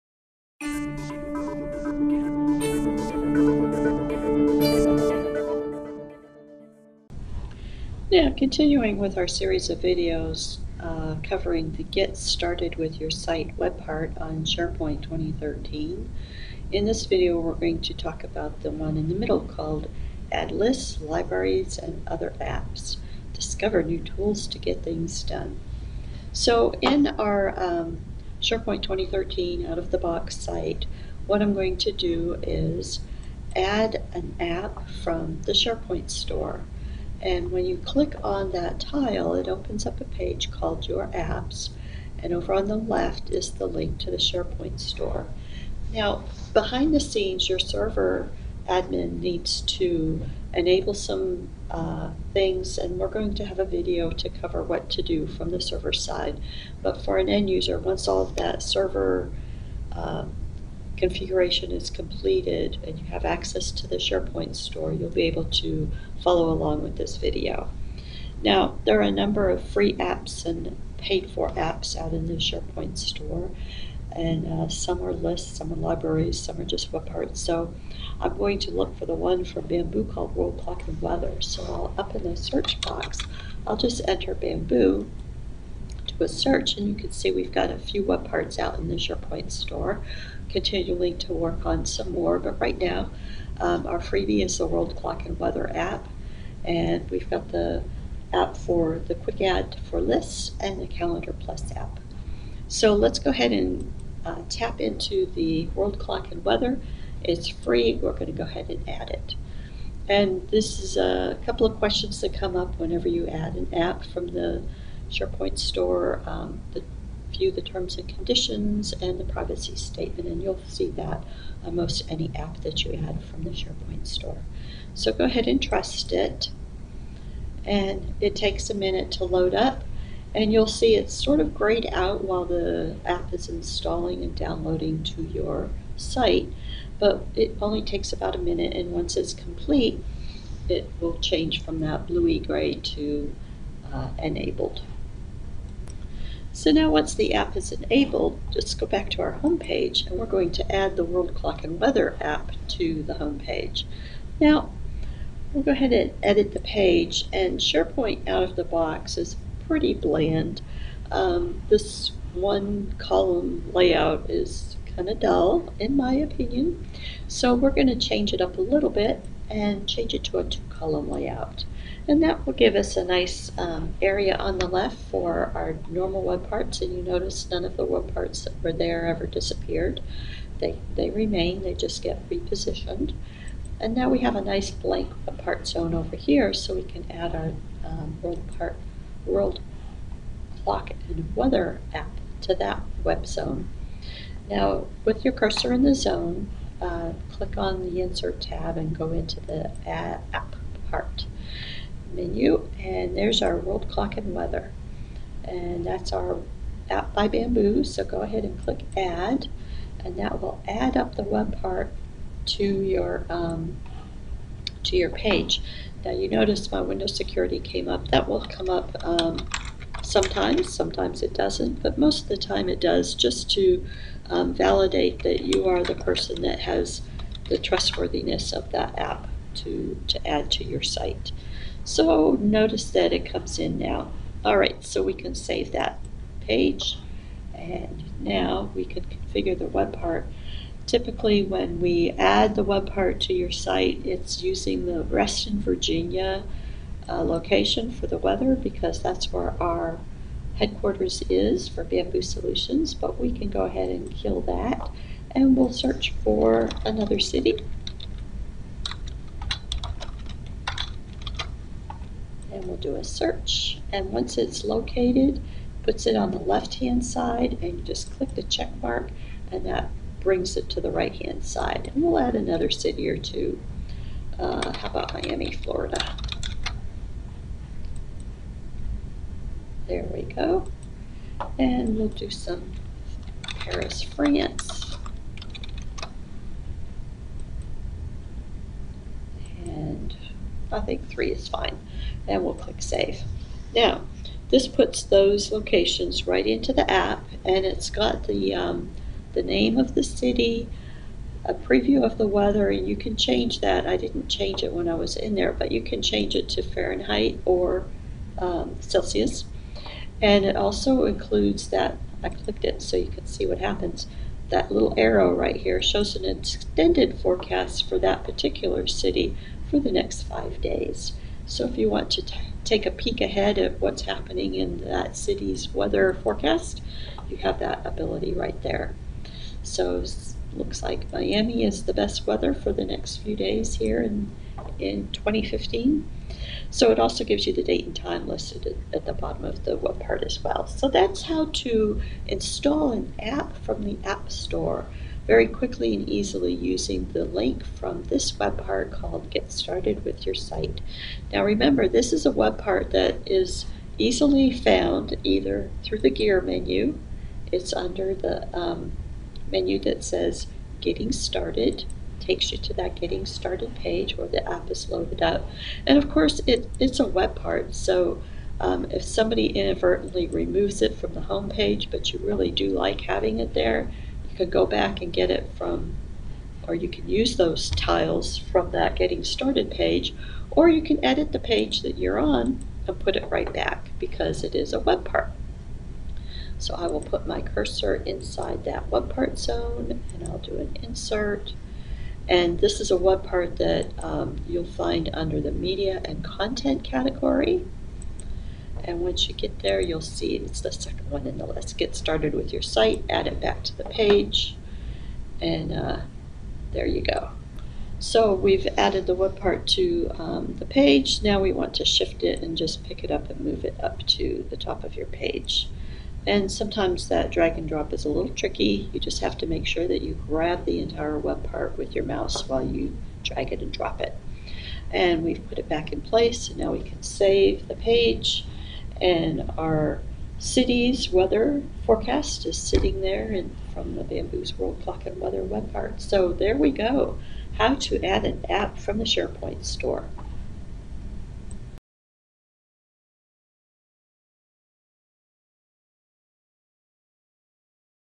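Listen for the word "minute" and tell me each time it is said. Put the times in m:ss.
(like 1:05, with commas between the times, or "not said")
2:08, 2:18.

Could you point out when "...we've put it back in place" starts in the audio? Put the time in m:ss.
7:05.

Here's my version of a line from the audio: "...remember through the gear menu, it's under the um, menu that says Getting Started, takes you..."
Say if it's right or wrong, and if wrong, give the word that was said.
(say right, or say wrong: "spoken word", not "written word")
wrong: "either", not "remember".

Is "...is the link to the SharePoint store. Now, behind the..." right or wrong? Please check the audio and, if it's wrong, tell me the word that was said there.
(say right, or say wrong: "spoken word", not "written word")
right.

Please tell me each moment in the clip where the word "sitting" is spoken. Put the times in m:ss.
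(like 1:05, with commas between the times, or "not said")
7:12.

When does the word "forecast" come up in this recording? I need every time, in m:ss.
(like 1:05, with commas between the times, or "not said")
5:17, 5:26, 7:11.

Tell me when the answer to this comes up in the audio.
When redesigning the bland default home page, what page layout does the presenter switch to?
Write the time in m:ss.
2:50.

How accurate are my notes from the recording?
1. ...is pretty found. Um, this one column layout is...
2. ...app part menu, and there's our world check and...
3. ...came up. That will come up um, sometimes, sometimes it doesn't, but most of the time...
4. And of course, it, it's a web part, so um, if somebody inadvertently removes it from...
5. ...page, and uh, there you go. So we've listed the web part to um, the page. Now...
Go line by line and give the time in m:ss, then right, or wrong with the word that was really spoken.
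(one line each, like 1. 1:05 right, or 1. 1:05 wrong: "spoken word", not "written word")
1. 2:39 wrong: "bland", not "found"
2. 3:19 wrong: "clock", not "check"
3. 3:37 right
4. 6:05 right
5. 6:43 wrong: "added", not "listed".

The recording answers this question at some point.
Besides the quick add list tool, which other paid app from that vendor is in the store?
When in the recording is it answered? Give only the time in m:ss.
1:40.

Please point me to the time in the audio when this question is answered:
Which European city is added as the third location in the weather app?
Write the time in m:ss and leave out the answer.
4:43.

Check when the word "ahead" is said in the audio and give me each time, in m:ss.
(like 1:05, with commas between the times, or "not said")
1:43, 1:48, 2:05, 2:35, 3:28, 4:13, 5:23.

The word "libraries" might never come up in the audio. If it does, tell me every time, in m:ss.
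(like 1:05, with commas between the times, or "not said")
0:21, 1:15.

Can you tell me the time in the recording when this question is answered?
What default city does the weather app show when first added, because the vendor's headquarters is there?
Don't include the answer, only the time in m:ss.
4:05.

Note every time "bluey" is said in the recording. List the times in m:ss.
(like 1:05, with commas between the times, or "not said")
2:22.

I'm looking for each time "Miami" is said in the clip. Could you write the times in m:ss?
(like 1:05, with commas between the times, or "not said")
4:35, 5:31.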